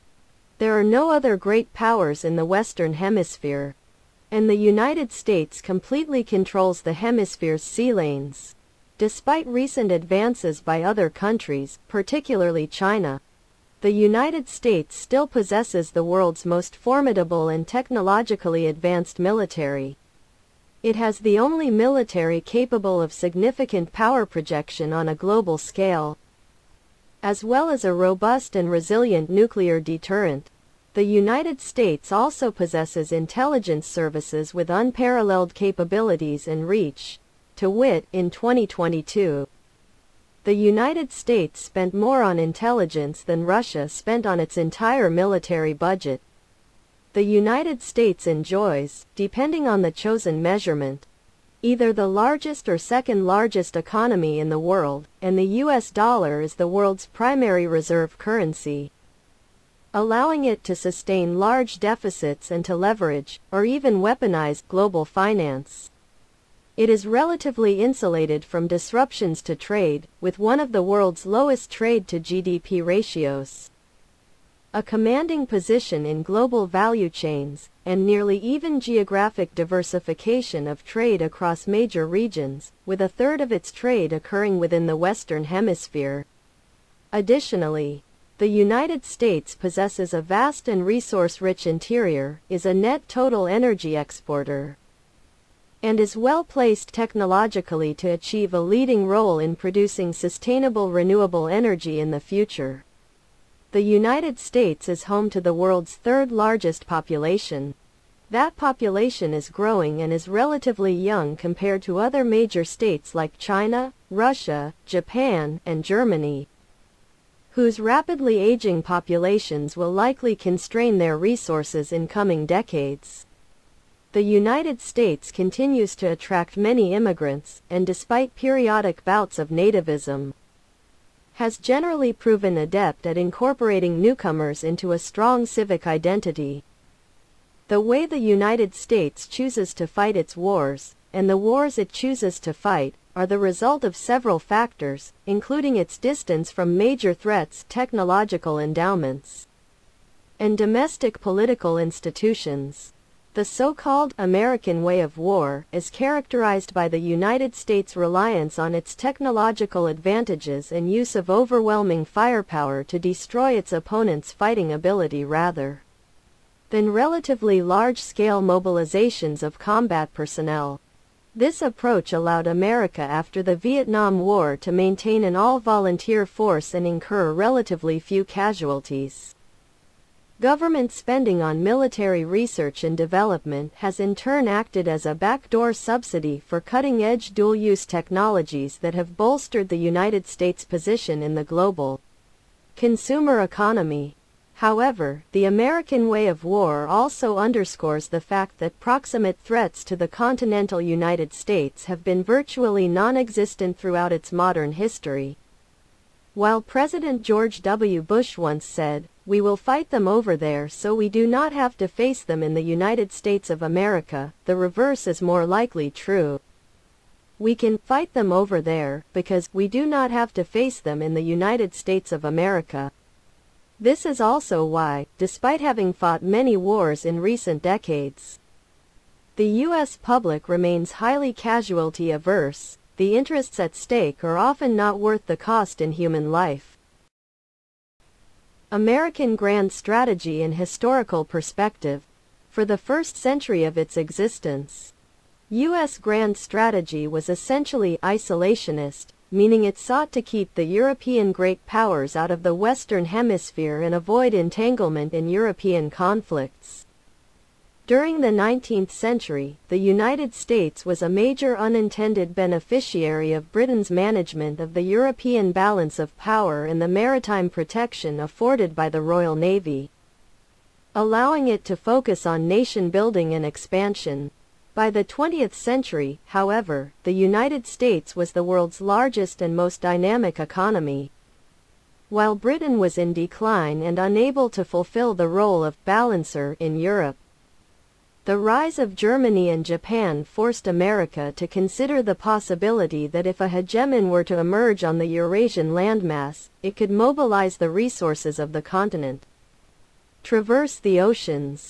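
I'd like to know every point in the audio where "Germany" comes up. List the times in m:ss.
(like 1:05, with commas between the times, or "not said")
1:55, 4:48.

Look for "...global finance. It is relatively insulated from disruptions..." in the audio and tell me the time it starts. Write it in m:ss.
1:04.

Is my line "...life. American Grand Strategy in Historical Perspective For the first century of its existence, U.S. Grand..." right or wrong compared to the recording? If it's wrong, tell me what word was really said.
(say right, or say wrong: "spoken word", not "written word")
right.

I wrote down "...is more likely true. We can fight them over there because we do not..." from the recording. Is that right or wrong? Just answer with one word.
right.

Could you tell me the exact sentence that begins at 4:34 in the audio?
By the 20th century, however, the United States was the world's largest and most dynamic economy.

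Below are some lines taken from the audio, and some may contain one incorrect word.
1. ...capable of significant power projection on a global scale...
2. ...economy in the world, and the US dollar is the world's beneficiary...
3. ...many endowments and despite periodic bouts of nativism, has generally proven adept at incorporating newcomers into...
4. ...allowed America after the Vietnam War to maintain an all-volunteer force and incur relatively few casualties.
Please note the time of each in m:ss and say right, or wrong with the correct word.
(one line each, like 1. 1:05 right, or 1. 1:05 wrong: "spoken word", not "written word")
1. 0:22 right
2. 0:53 wrong: "primary", not "beneficiary"
3. 2:06 wrong: "immigrants", not "endowments"
4. 2:52 right.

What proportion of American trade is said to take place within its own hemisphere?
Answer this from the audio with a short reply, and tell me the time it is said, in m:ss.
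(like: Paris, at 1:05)
A third, at 1:22.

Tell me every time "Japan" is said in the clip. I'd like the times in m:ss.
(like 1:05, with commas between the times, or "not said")
1:54, 4:49.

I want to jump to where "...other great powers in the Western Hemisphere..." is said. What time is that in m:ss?
0:01.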